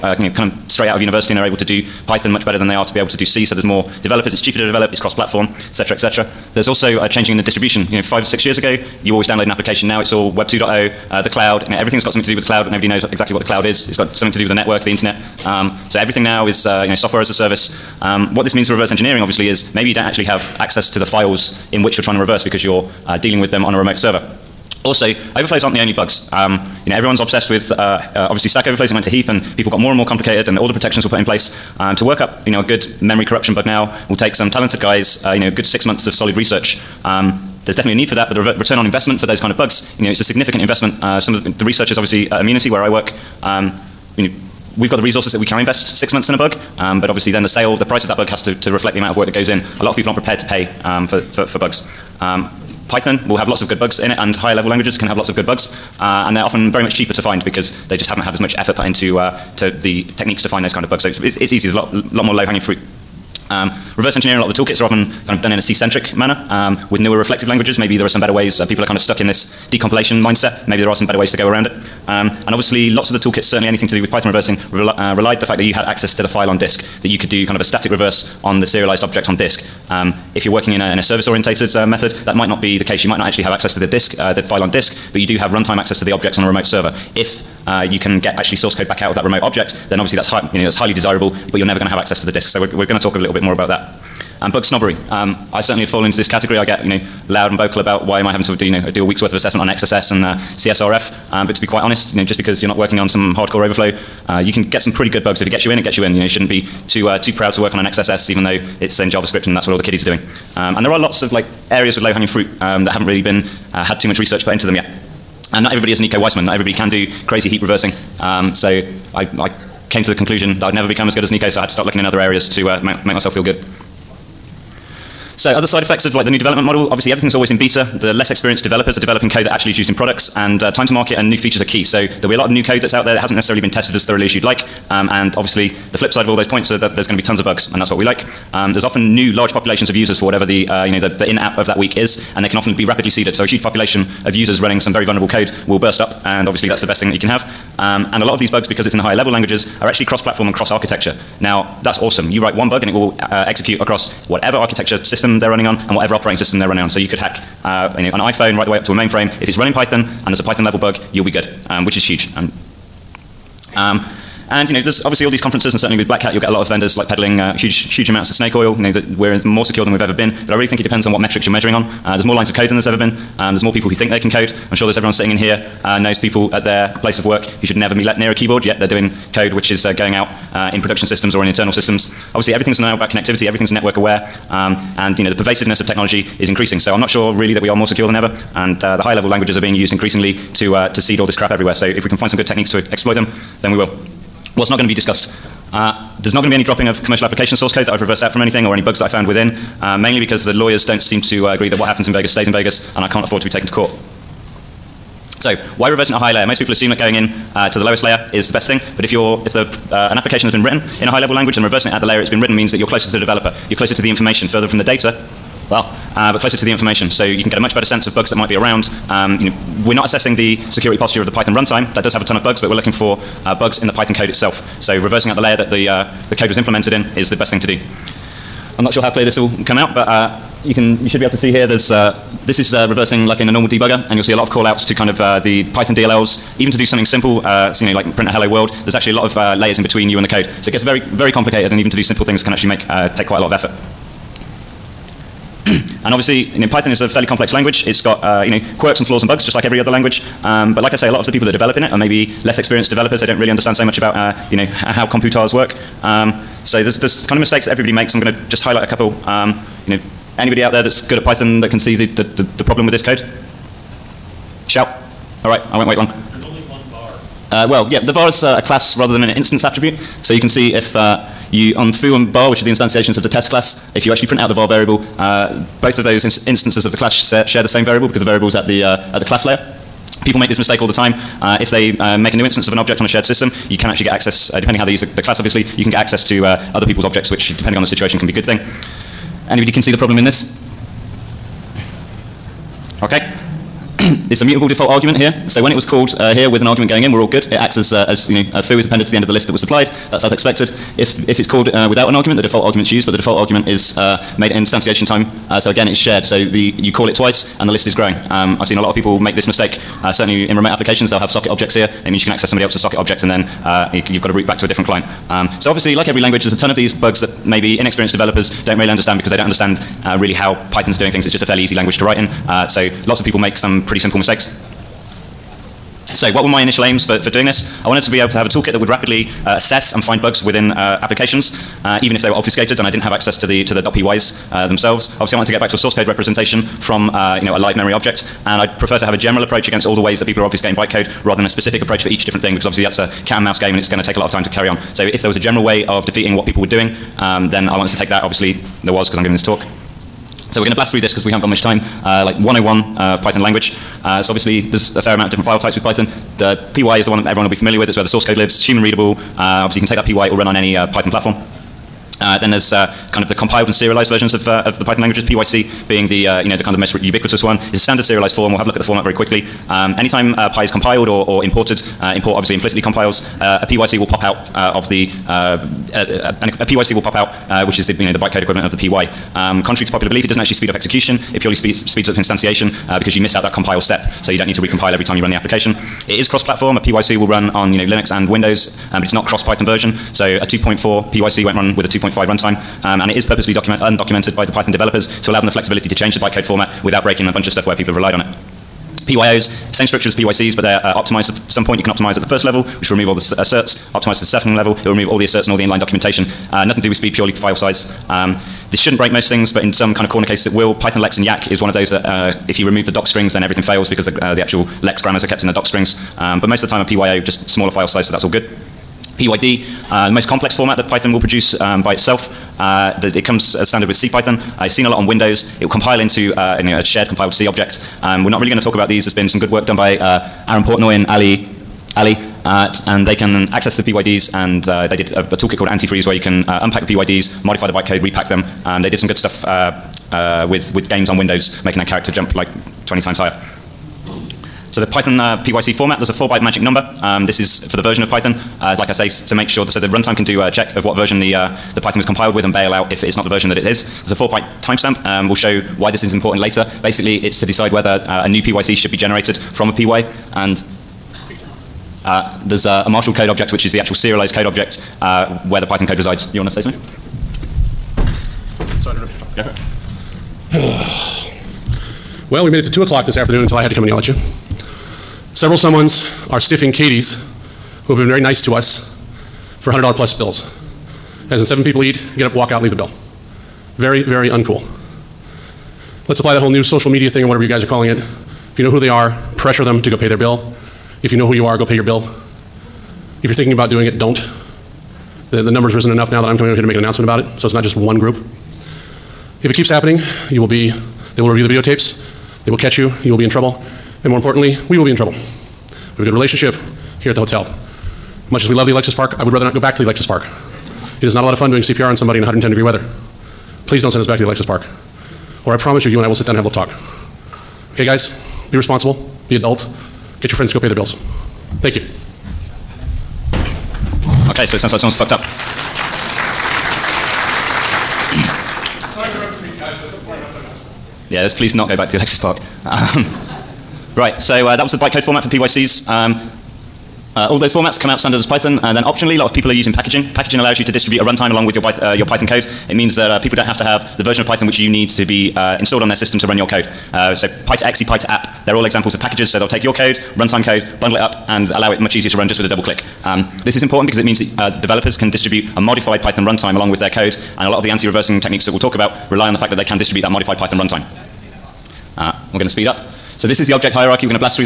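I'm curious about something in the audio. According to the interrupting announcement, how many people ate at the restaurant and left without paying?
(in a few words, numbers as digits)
7.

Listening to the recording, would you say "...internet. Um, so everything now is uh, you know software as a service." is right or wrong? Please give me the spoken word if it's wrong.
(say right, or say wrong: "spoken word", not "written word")
right.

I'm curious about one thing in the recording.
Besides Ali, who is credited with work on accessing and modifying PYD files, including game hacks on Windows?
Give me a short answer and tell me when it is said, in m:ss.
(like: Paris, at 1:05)
Aaron Portnoy, at 7:10.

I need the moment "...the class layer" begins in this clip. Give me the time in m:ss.
4:39.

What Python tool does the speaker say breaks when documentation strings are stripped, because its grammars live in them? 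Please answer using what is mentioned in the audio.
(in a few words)
Python Lex and Yacc.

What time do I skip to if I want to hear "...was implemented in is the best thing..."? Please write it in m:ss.
3:46.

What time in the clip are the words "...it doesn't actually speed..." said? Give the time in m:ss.
6:20.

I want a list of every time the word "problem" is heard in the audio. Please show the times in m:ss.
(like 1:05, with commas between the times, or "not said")
4:22, 4:49.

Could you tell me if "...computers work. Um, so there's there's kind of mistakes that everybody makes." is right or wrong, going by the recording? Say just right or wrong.
right.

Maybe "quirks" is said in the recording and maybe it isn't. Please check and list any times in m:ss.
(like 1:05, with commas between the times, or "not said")
4:08.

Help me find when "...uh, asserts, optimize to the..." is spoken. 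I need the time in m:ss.
6:43.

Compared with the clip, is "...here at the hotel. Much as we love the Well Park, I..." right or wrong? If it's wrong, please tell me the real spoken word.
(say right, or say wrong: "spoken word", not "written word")
wrong: "Alexis", not "Well".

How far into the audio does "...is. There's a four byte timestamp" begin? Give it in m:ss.
7:33.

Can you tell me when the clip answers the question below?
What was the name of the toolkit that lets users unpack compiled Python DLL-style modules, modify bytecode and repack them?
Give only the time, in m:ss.
7:15.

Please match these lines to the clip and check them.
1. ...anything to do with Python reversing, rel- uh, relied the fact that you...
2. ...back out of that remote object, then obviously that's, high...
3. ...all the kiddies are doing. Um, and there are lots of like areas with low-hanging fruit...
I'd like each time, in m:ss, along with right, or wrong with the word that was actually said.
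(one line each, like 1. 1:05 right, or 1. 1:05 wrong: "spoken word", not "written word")
1. 1:13 right
2. 1:28 right
3. 1:49 right.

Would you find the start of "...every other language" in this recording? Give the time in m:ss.
4:09.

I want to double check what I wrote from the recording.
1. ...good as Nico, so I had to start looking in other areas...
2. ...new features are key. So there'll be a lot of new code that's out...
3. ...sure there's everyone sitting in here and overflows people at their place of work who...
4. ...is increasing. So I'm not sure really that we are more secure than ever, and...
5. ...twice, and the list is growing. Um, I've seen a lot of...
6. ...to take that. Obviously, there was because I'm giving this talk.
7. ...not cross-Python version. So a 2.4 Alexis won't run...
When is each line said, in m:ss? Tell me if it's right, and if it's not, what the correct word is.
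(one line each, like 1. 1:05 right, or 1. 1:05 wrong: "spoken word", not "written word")
1. 2:01 right
2. 2:11 right
3. 2:54 wrong: "knows", not "overflows"
4. 3:06 right
5. 5:07 right
6. 5:47 right
7. 6:29 wrong: "PYC", not "Alexis".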